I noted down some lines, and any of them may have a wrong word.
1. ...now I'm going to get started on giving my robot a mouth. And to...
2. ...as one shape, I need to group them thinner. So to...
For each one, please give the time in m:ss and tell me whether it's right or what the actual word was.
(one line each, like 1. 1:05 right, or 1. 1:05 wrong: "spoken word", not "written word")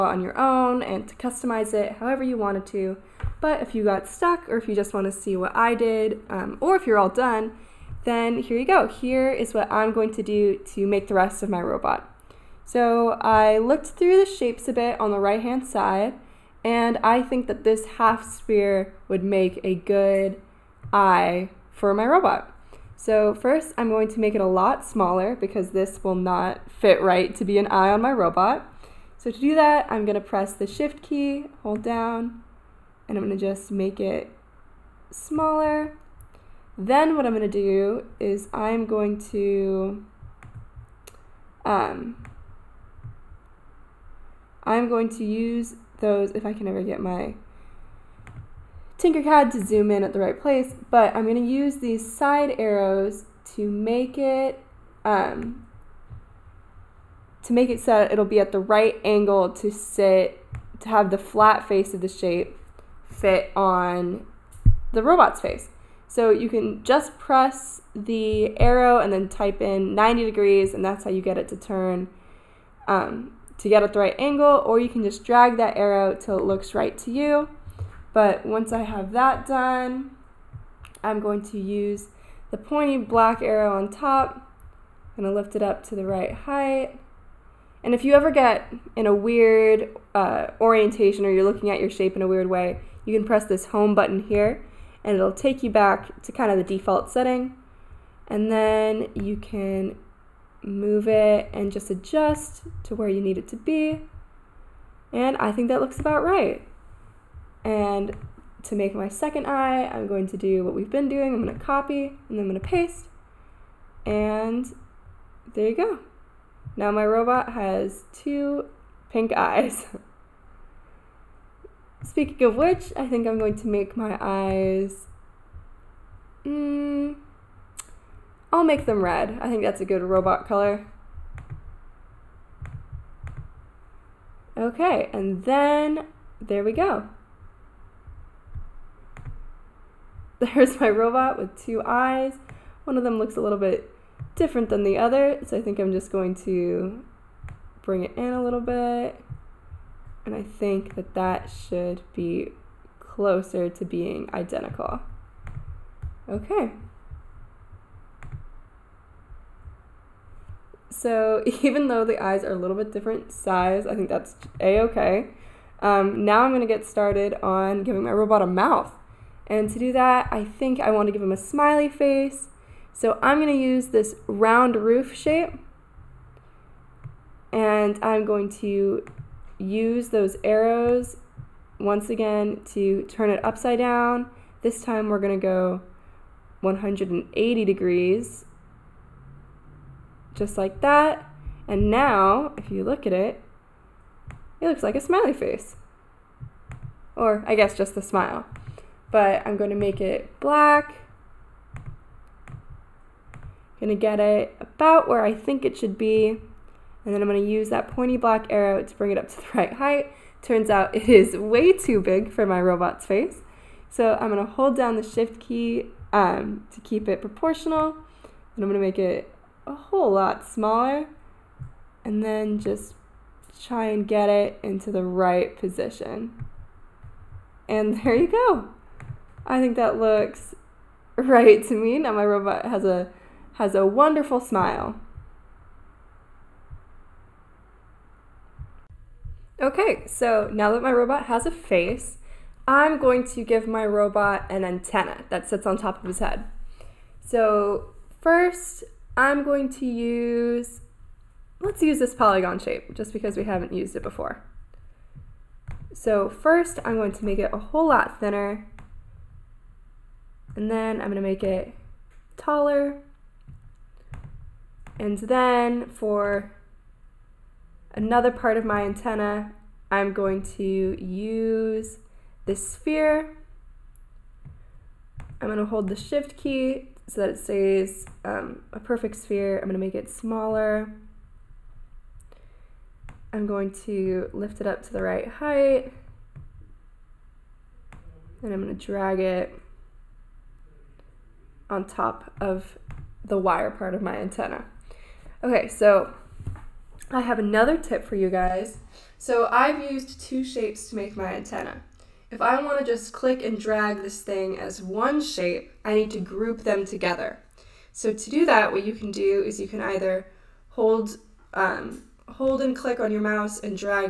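1. 2:46 right
2. 5:04 wrong: "together", not "thinner".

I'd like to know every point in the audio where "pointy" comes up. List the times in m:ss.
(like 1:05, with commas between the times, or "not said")
1:22, 3:27.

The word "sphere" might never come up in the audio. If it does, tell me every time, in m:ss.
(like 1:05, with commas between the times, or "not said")
0:18, 4:32, 4:39.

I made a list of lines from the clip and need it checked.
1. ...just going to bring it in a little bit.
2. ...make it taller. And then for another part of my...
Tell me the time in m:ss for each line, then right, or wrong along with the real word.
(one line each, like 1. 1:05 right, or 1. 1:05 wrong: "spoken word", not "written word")
1. 2:25 right
2. 4:21 right.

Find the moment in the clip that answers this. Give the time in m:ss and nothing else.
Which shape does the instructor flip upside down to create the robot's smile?
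2:54.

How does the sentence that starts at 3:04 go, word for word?
This time we're going to go 180 degrees just like that.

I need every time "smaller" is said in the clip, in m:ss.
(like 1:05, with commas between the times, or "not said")
0:24, 0:35, 3:40, 4:40.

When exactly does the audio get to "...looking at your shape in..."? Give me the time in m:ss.
1:31.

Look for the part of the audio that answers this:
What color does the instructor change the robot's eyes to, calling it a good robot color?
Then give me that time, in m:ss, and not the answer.
2:09.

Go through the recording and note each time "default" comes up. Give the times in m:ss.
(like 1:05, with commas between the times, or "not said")
1:36.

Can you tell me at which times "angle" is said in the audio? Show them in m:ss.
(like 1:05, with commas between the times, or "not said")
0:59, 1:14.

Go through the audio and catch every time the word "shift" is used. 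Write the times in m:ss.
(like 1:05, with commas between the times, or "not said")
0:30, 3:35, 4:35.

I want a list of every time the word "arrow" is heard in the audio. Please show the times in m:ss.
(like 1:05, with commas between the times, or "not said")
0:52, 1:08, 1:15, 1:23, 3:00, 3:28.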